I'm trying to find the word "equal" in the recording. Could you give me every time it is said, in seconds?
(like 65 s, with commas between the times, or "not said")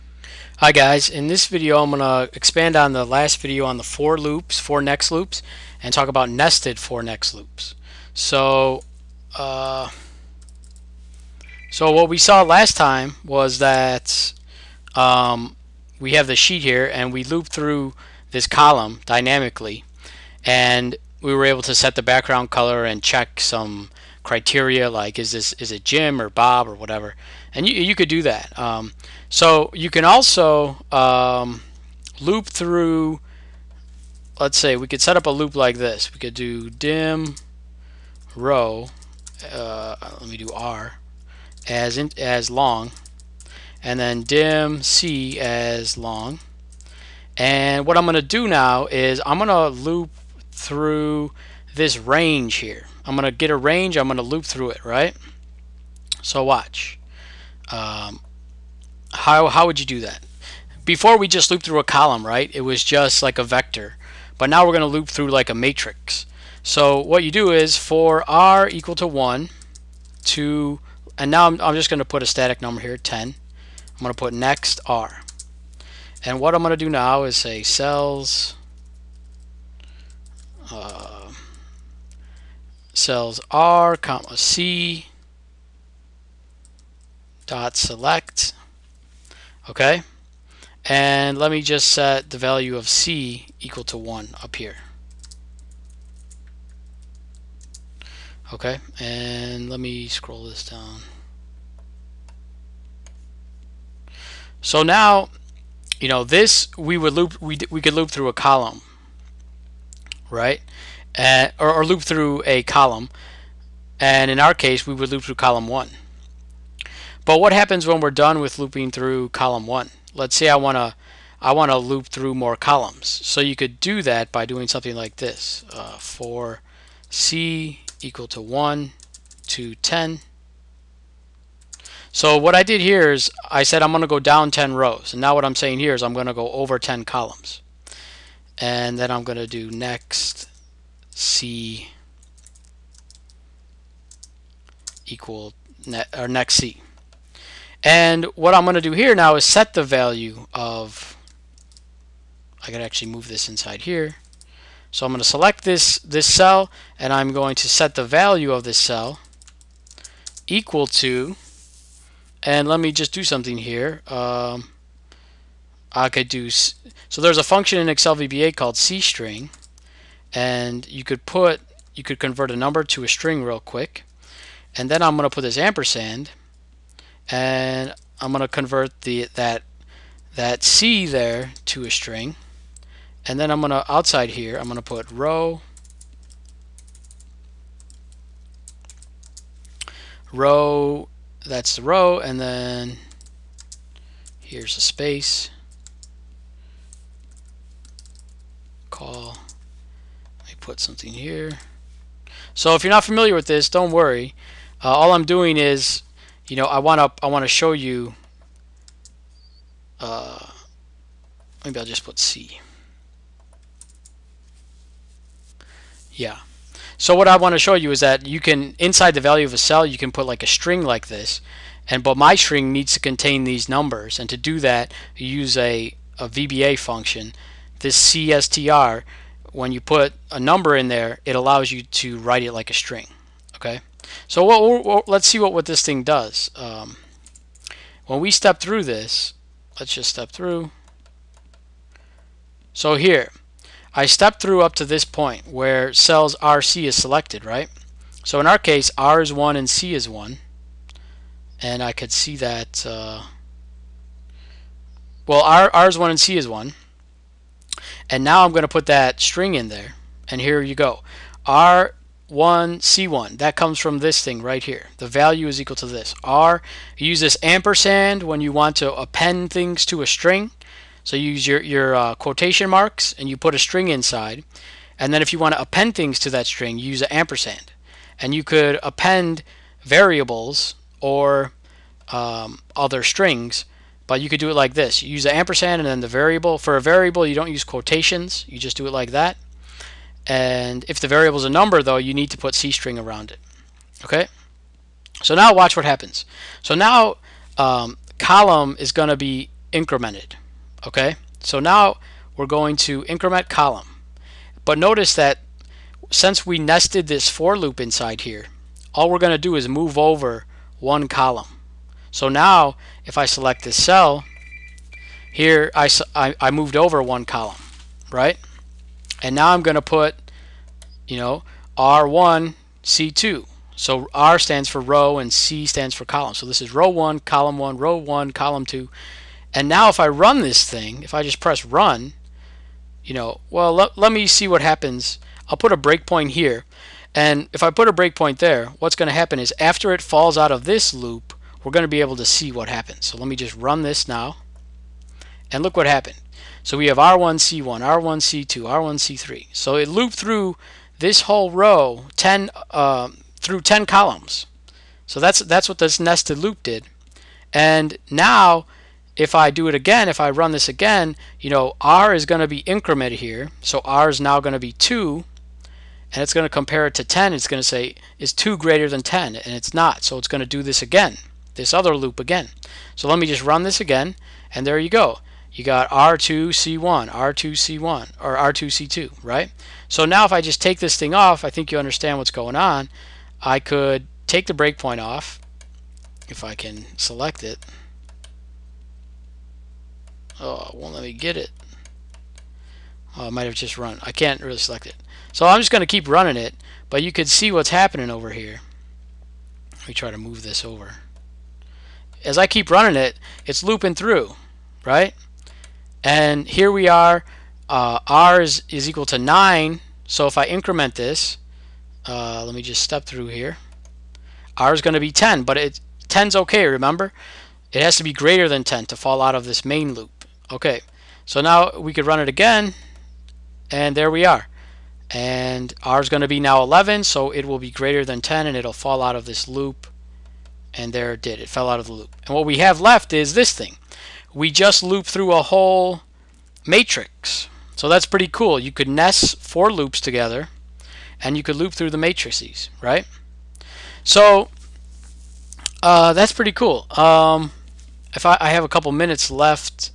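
68 s, 93 s, 128 s, 145 s, 160 s, 265 s, 408 s.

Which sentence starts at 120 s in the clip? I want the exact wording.
Let's say I want to I want to loop through more columns.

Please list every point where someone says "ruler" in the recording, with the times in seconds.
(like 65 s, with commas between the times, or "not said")
not said.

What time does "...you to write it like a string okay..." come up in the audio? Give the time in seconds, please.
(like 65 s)
231 s.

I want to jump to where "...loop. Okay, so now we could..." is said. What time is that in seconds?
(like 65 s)
419 s.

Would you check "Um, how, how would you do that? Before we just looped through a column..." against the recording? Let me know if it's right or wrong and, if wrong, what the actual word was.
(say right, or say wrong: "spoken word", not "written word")
right.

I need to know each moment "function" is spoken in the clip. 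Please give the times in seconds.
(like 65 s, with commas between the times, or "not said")
167 s, 226 s.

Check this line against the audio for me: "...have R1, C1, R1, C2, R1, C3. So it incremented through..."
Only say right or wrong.
wrong.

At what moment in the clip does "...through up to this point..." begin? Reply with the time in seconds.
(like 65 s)
244 s.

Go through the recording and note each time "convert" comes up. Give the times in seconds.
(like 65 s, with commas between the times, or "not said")
172 s, 178 s.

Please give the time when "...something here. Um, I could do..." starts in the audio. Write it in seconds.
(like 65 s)
163 s.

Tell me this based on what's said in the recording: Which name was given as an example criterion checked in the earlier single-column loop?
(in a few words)
Bob.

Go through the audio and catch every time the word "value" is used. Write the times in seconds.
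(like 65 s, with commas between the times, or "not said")
92 s, 149 s, 158 s, 219 s, 265 s.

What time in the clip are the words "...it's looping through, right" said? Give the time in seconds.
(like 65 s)
403 s.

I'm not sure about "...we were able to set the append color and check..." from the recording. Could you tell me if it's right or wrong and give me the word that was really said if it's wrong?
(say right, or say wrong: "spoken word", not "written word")
wrong: "background", not "append".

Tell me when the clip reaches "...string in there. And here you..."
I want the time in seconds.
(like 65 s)
259 s.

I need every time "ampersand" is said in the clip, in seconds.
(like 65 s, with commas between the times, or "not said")
175 s, 267 s, 277 s, 285 s.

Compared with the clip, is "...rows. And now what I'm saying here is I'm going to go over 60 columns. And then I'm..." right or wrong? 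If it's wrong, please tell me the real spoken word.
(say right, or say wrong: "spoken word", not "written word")
wrong: "10", not "60".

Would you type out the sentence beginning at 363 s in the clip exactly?
So R is now going to be 2 and it's going to compare it to 10.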